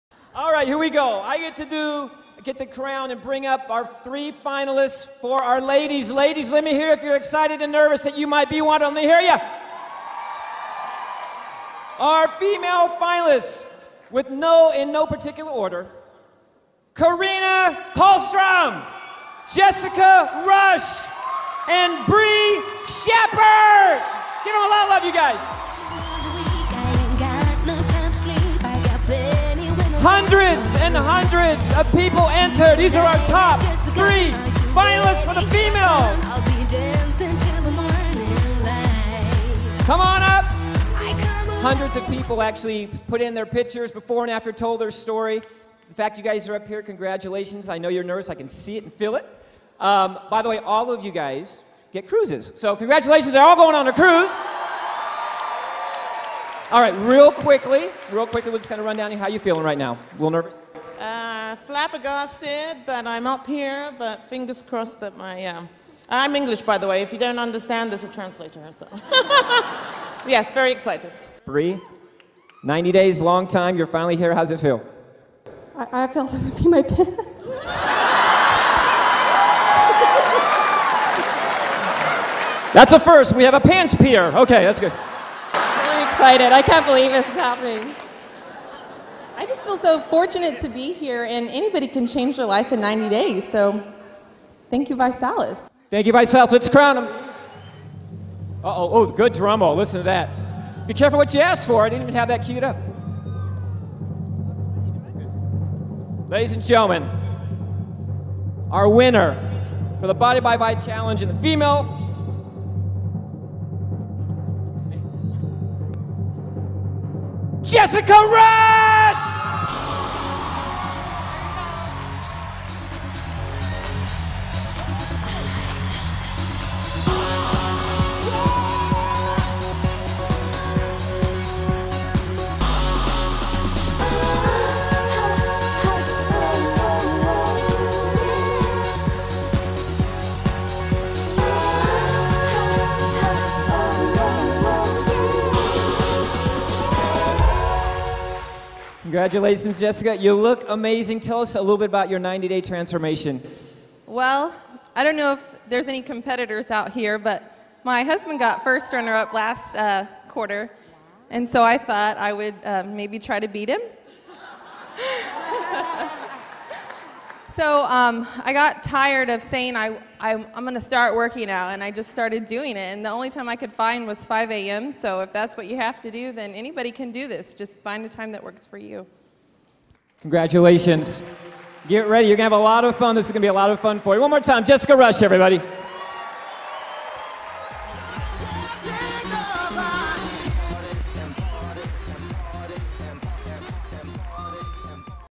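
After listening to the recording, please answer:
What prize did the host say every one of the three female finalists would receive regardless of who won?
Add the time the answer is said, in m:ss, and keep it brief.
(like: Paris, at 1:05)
Cruises, at 0:52.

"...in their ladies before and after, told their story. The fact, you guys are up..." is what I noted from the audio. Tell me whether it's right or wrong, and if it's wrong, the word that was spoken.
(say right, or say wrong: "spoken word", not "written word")
wrong: "pictures", not "ladies".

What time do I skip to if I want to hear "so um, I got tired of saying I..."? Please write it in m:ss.
2:47.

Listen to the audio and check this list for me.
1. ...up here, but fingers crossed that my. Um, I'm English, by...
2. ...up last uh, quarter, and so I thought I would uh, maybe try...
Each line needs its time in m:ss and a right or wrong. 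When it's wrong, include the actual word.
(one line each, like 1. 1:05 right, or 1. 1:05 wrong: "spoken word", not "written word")
1. 1:03 right
2. 2:39 right.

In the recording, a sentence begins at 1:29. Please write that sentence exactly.
I just feel so fortunate to be here, and anybody can change their life in 90 days.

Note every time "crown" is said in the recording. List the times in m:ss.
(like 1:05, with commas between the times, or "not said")
0:02, 1:36.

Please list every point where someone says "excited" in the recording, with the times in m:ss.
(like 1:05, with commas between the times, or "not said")
0:07, 1:10, 1:26.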